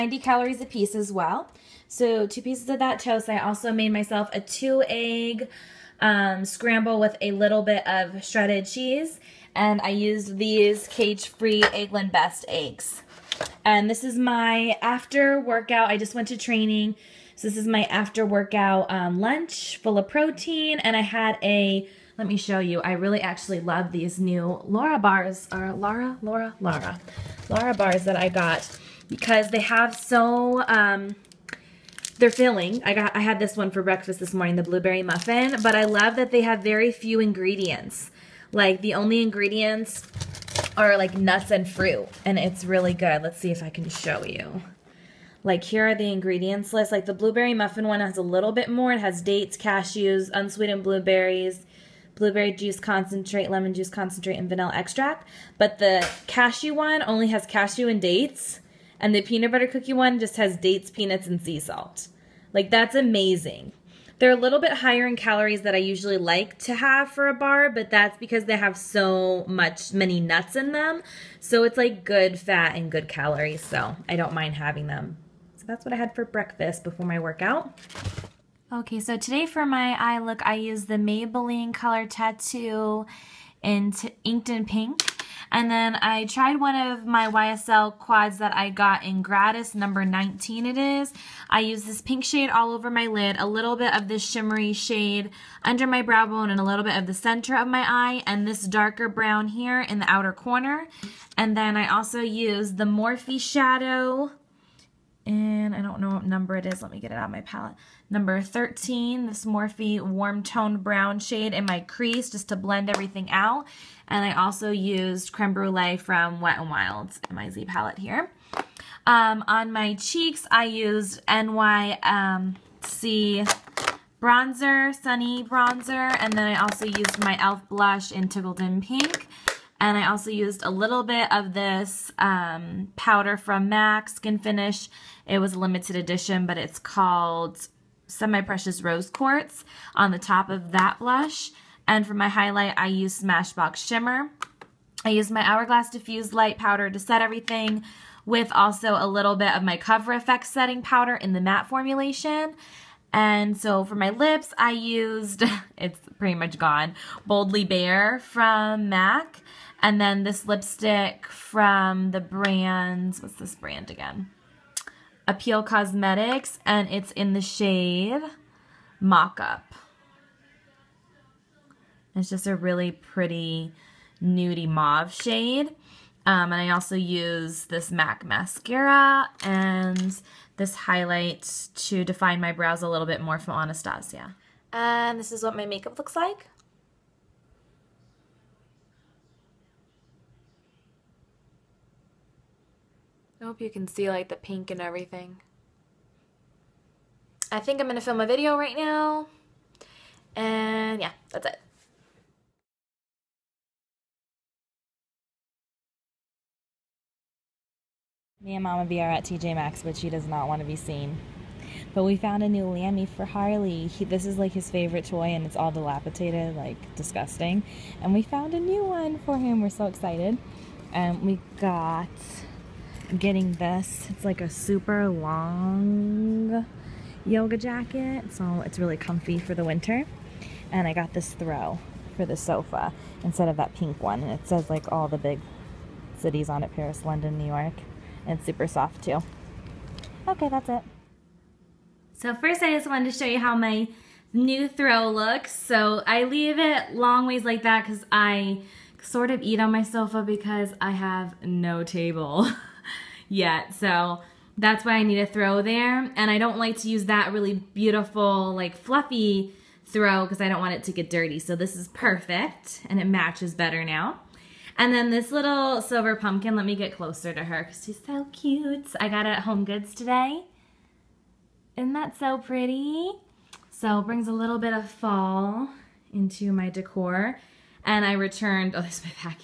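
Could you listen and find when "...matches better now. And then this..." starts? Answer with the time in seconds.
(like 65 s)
263 s.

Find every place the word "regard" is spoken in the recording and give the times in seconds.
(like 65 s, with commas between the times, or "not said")
not said.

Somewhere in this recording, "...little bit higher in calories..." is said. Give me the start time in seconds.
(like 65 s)
64 s.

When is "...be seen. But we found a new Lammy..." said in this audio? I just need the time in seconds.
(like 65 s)
210 s.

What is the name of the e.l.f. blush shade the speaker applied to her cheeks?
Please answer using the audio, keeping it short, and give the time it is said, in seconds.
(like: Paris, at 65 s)
Tickled in Pink, at 128 s.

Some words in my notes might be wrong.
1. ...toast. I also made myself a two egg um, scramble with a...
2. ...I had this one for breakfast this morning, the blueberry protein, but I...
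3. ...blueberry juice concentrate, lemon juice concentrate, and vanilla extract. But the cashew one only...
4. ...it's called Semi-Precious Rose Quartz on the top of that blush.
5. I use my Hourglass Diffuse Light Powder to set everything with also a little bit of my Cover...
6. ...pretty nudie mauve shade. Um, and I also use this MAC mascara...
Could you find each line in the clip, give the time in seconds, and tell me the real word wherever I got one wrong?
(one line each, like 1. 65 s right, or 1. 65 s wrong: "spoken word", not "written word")
1. 2 s right
2. 33 s wrong: "muffin", not "protein"
3. 52 s right
4. 136 s right
5. 145 s right
6. 172 s right.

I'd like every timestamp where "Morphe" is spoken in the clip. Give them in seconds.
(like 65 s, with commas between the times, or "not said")
102 s, 109 s.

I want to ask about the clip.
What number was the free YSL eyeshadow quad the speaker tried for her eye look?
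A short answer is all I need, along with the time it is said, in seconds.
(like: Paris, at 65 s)
19, at 89 s.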